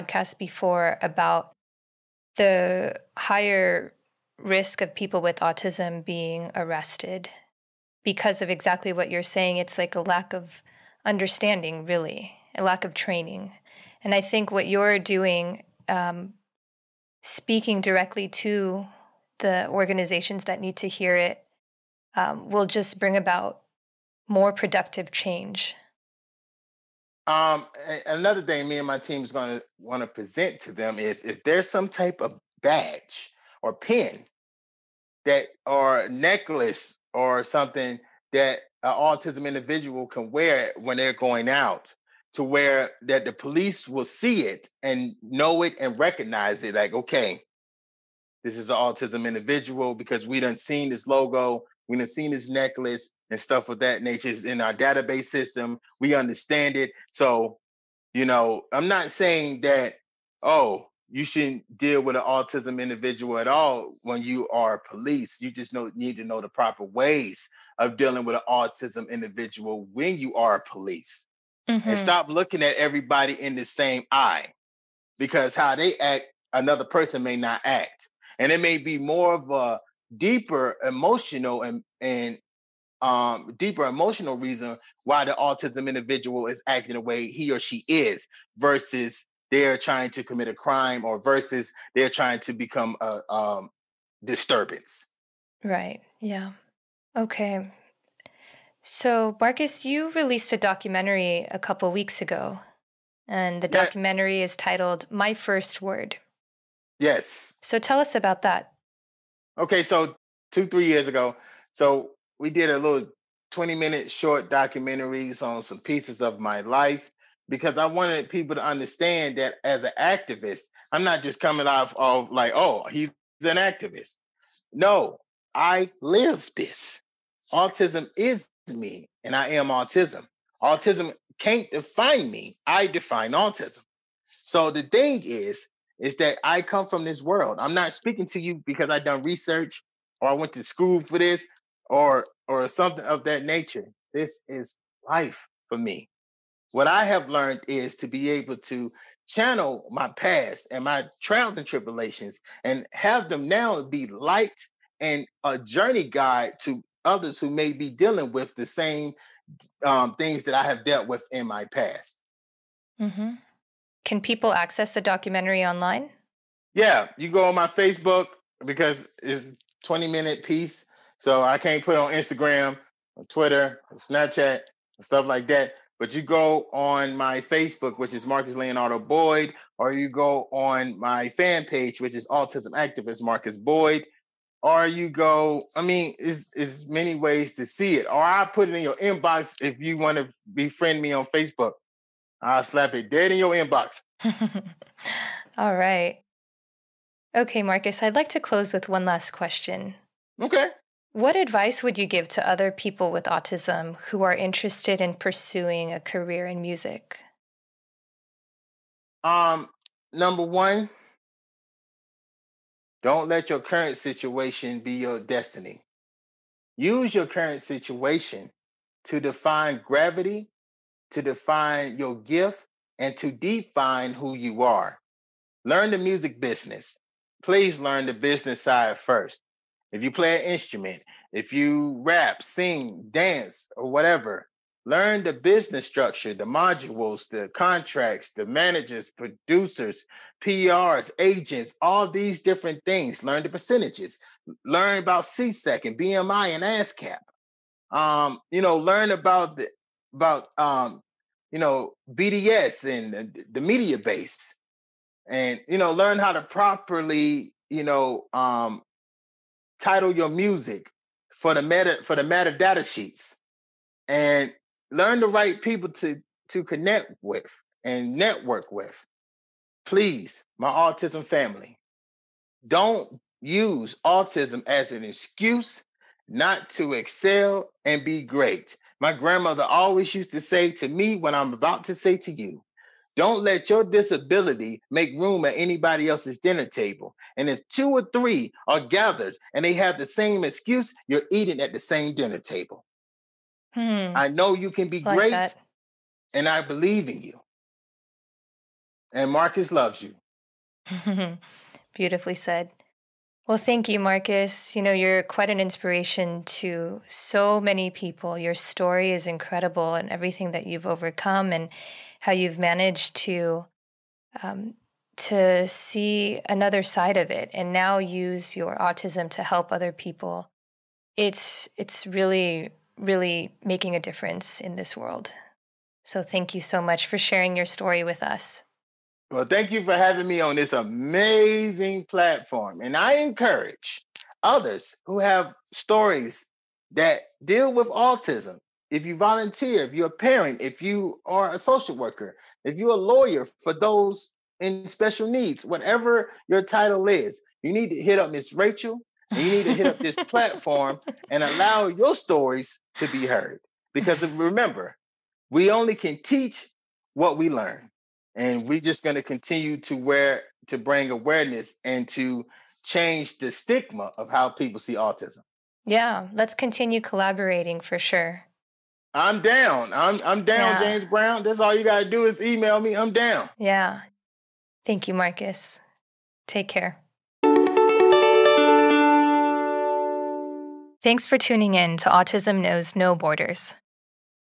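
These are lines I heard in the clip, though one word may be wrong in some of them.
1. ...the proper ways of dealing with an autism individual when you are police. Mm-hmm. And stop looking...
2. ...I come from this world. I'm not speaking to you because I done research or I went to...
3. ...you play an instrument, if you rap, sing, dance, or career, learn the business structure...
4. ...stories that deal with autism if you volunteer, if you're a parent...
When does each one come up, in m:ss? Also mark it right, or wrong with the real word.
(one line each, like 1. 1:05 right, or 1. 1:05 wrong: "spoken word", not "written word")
1. 1:06 right
2. 2:16 right
3. 3:50 wrong: "whatever", not "career"
4. 5:35 right.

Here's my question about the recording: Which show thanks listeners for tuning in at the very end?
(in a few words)
Autism Knows No Borders.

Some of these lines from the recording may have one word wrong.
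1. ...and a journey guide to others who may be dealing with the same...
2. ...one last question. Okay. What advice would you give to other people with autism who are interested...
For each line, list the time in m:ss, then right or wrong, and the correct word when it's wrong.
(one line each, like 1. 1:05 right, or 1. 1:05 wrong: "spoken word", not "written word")
1. 2:34 right
2. 3:18 right.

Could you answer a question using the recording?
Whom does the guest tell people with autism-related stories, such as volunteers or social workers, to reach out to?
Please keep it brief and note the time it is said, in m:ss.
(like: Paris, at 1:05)
Miss Rachel, at 5:48.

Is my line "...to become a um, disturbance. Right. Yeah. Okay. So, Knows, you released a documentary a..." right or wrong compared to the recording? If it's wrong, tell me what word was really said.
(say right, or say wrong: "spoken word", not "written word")
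wrong: "Marcus", not "Knows".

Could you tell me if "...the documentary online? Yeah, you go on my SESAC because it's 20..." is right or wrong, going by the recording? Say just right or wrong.
wrong.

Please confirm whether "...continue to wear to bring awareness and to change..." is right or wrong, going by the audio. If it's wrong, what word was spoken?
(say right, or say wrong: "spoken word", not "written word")
right.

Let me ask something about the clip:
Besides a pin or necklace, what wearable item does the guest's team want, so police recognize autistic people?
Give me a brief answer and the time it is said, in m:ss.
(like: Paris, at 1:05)
badge, at 0:32.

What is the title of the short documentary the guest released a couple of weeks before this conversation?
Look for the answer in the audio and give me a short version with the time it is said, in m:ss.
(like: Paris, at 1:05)
My First Word, at 1:45.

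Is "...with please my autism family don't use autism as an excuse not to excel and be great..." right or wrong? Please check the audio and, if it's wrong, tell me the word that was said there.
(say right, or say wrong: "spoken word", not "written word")
right.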